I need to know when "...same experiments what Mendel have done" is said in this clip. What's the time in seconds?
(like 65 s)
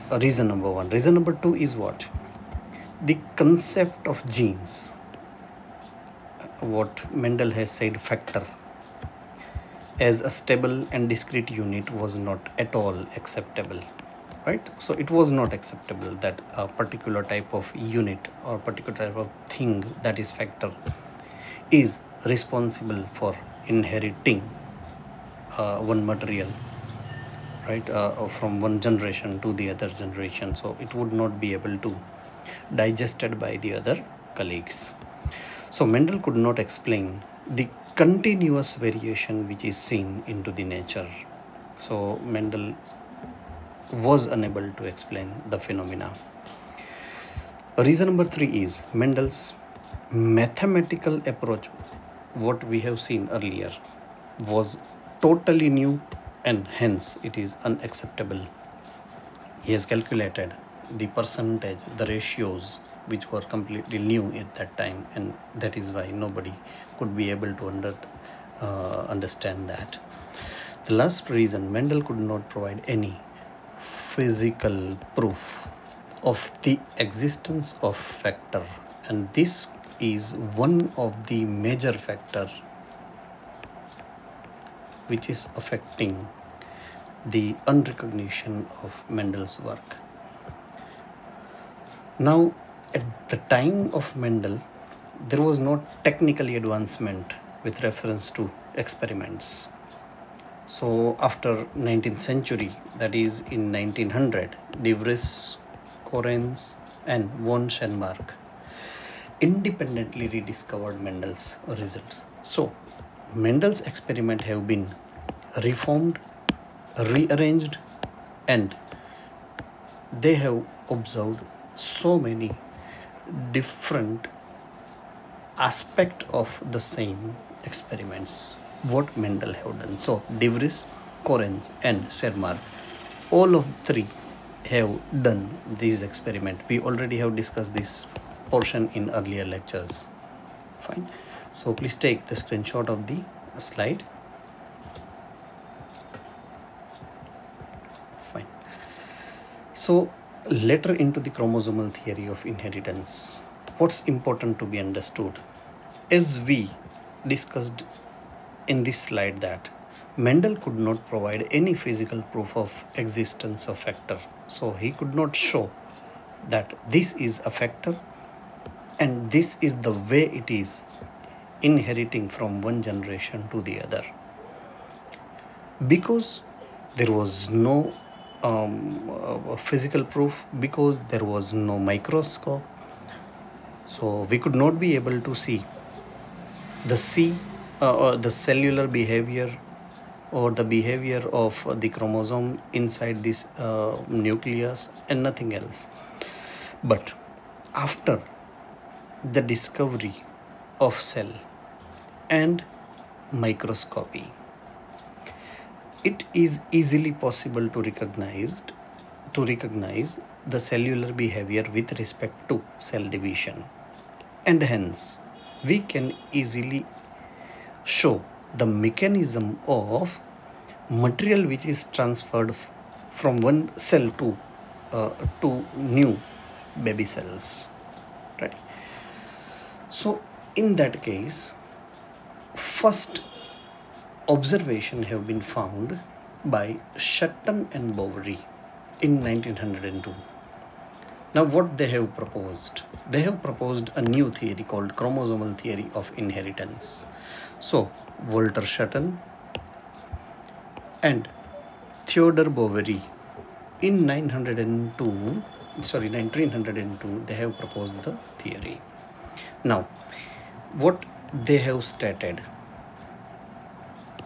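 126 s.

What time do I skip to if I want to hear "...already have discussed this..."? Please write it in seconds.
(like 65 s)
136 s.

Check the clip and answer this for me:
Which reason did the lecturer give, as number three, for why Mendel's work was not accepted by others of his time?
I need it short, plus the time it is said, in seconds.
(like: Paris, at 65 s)
Mendel's mathematical approach, at 49 s.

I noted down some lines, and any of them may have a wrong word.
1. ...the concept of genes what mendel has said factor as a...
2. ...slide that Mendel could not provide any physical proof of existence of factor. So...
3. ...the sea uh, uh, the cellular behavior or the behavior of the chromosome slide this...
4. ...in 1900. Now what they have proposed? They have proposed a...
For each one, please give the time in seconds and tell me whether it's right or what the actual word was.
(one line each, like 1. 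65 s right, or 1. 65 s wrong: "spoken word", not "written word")
1. 3 s right
2. 158 s right
3. 186 s wrong: "inside", not "slide"
4. 238 s wrong: "1902", not "1900".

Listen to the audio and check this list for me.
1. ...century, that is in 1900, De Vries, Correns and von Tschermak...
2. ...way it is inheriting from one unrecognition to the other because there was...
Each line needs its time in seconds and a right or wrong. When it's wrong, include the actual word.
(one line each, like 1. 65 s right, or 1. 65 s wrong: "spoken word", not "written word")
1. 102 s right
2. 169 s wrong: "generation", not "unrecognition".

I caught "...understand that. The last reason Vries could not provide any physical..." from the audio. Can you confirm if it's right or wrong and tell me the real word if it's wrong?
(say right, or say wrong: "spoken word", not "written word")
wrong: "Mendel", not "Vries".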